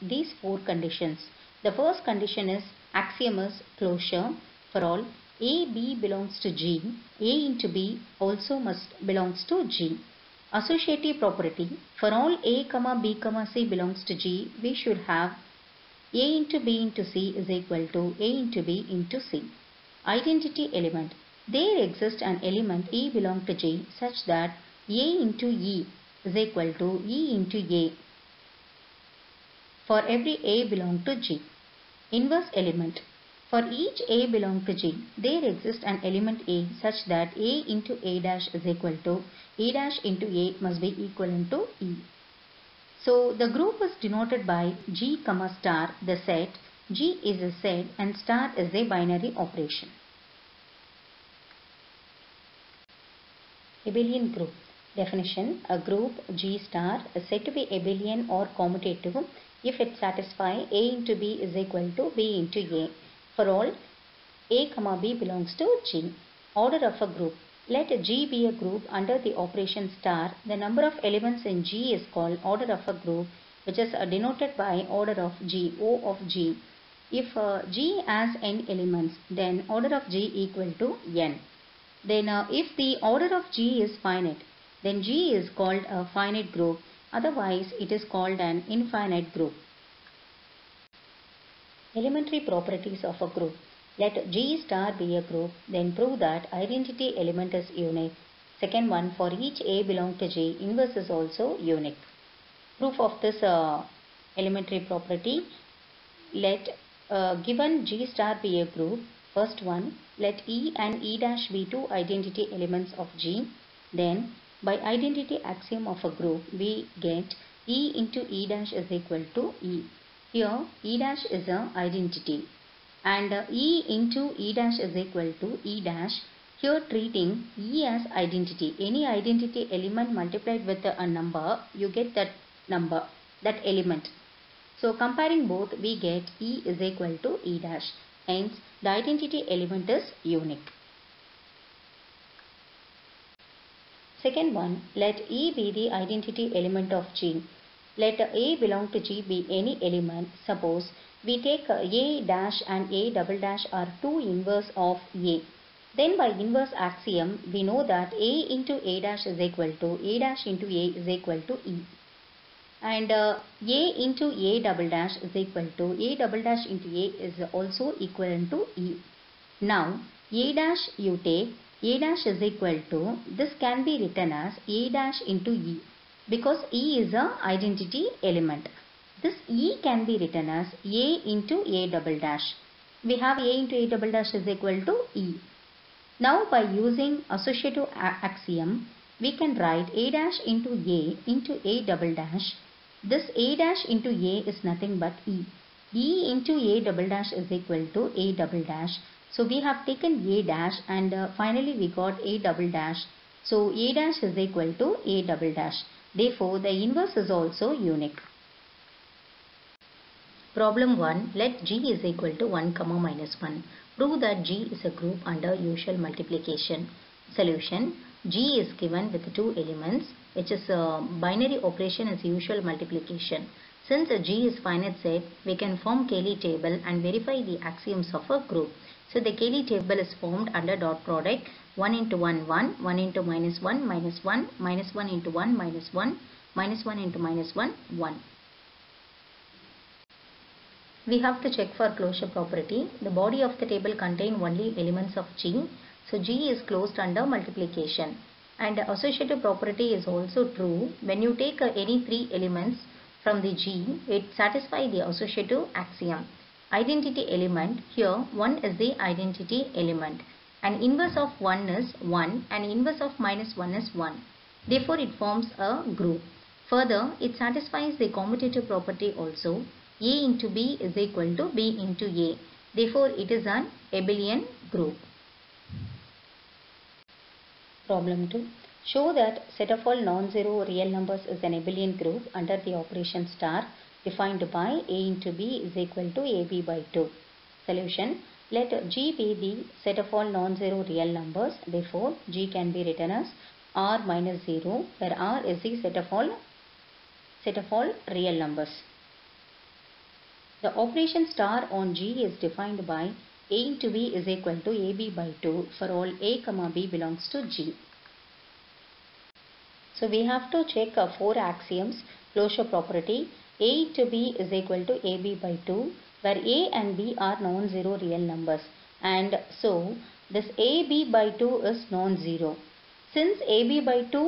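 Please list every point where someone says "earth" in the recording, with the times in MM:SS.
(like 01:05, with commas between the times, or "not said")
not said.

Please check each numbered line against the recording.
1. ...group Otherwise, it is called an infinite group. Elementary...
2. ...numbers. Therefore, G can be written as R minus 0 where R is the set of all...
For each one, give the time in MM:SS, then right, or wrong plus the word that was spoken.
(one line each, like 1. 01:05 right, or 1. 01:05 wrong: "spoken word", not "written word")
1. 01:26 right
2. 04:51 right.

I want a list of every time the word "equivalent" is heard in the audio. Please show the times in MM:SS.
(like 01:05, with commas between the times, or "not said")
00:41, 02:48.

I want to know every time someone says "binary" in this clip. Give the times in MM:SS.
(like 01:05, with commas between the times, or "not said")
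00:48, 03:41.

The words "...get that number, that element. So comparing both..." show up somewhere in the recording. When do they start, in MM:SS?
02:11.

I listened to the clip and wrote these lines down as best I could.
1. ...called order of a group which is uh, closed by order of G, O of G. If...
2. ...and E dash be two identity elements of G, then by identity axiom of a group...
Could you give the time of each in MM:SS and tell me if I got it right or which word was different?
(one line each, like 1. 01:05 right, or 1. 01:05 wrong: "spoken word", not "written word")
1. 01:12 wrong: "denoted", not "closed"
2. 01:50 right.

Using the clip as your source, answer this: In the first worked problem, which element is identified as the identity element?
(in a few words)
1.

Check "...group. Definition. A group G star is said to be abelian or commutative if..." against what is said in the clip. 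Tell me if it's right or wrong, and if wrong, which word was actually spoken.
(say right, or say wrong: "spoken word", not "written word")
right.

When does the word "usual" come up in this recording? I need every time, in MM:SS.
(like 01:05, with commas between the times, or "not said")
03:35, 03:42.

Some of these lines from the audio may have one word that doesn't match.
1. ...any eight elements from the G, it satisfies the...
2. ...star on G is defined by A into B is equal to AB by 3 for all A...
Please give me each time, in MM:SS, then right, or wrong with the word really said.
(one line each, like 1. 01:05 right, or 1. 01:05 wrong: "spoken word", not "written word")
1. 04:11 wrong: "three", not "eight"
2. 05:01 wrong: "2", not "3".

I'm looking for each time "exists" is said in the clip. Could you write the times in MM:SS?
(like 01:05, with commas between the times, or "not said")
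00:21, 00:35.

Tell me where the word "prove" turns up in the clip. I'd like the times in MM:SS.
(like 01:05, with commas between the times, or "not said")
01:35, 03:33.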